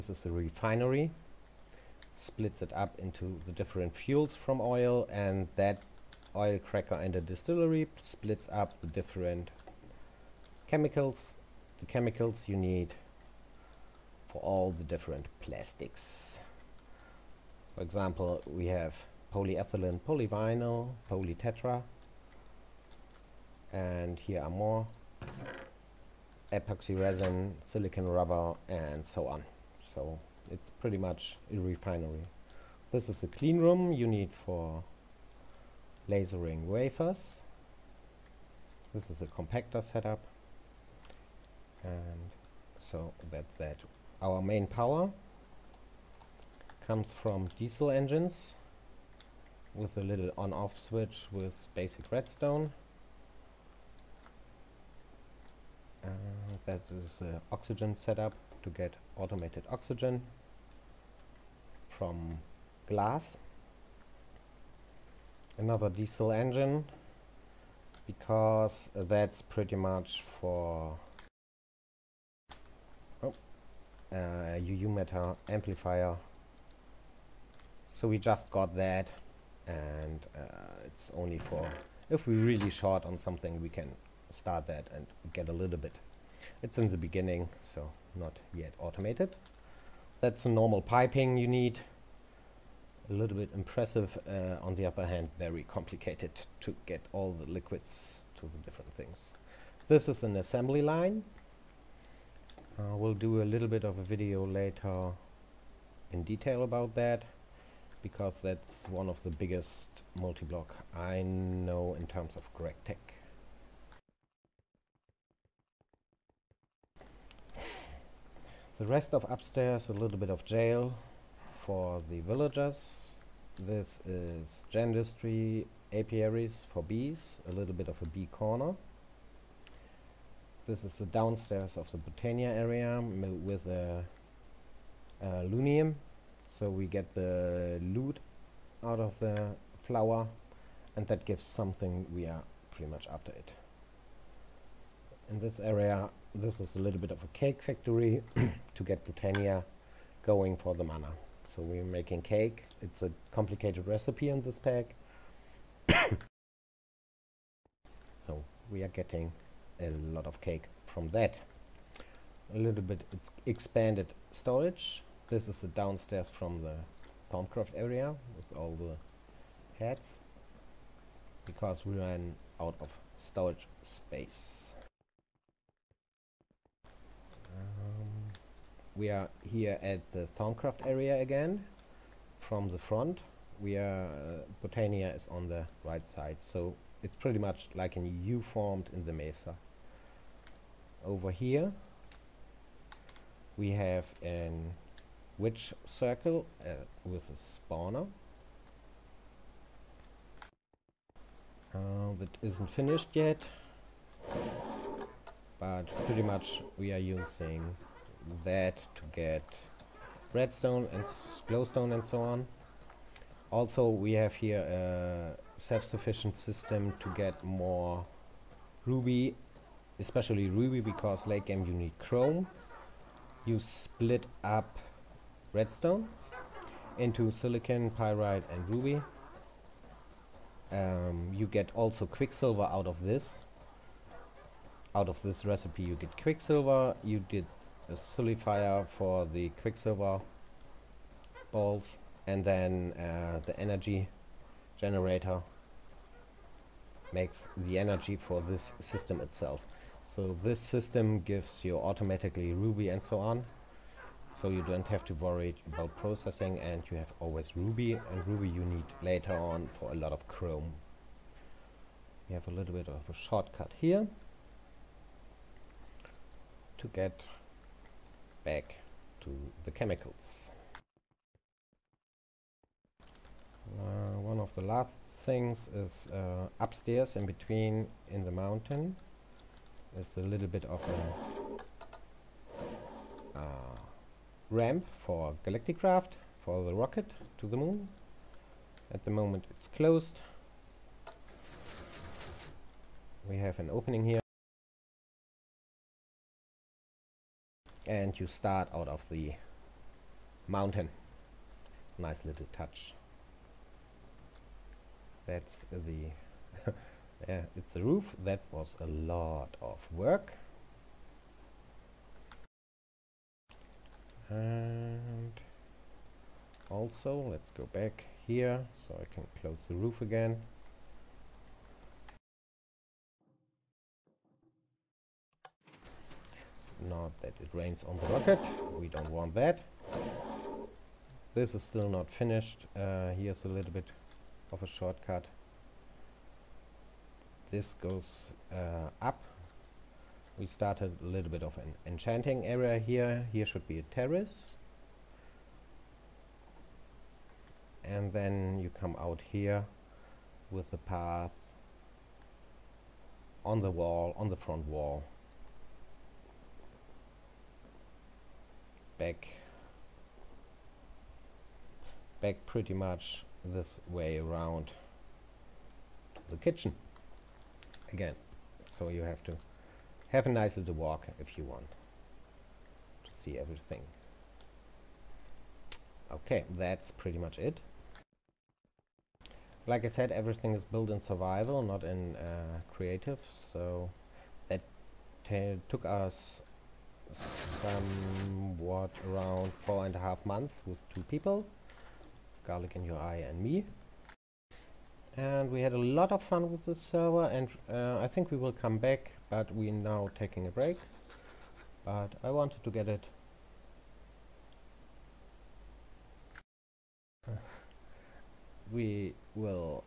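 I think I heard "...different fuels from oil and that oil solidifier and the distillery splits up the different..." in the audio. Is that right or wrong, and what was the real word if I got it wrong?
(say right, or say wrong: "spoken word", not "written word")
wrong: "cracker", not "solidifier".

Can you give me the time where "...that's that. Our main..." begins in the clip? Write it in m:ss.
0:43.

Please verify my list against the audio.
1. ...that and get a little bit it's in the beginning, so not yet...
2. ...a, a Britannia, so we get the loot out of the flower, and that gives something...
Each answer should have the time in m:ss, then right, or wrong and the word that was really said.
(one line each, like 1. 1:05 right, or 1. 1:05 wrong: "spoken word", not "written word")
1. 1:24 right
2. 2:13 wrong: "Loonium", not "Britannia".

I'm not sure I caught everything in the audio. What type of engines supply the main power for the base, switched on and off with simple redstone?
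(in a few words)
Diesel engines.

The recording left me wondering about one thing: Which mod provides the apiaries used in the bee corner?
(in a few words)
Gendustry.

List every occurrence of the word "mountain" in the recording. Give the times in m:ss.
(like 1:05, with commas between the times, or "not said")
4:38, 5:00.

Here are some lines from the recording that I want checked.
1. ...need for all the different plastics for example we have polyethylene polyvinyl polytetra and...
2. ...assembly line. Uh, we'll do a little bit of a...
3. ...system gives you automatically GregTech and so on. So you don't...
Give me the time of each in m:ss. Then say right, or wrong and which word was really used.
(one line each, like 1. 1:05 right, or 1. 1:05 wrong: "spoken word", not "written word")
1. 0:12 right
2. 1:40 right
3. 4:10 wrong: "Ruby", not "GregTech".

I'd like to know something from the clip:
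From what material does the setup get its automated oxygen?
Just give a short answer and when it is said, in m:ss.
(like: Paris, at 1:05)
Glass, at 1:02.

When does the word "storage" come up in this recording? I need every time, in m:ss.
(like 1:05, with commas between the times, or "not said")
2:44, 2:53.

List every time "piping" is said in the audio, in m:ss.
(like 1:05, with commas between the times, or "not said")
1:30.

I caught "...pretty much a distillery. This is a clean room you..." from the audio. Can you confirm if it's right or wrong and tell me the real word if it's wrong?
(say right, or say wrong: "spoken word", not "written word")
wrong: "refinery", not "distillery".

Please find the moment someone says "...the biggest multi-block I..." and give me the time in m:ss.
1:49.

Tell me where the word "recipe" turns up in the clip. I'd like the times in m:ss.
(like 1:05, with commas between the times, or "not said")
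2:33, 3:55.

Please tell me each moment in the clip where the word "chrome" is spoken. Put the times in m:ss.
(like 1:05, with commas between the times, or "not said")
3:41, 4:20.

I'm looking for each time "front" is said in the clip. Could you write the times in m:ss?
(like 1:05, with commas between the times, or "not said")
3:02, 5:54.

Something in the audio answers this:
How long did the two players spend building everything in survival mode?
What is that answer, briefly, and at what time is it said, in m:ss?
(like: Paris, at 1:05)
Four and a half months, at 6:29.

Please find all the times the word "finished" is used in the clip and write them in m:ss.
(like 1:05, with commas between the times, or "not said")
3:22, 5:32.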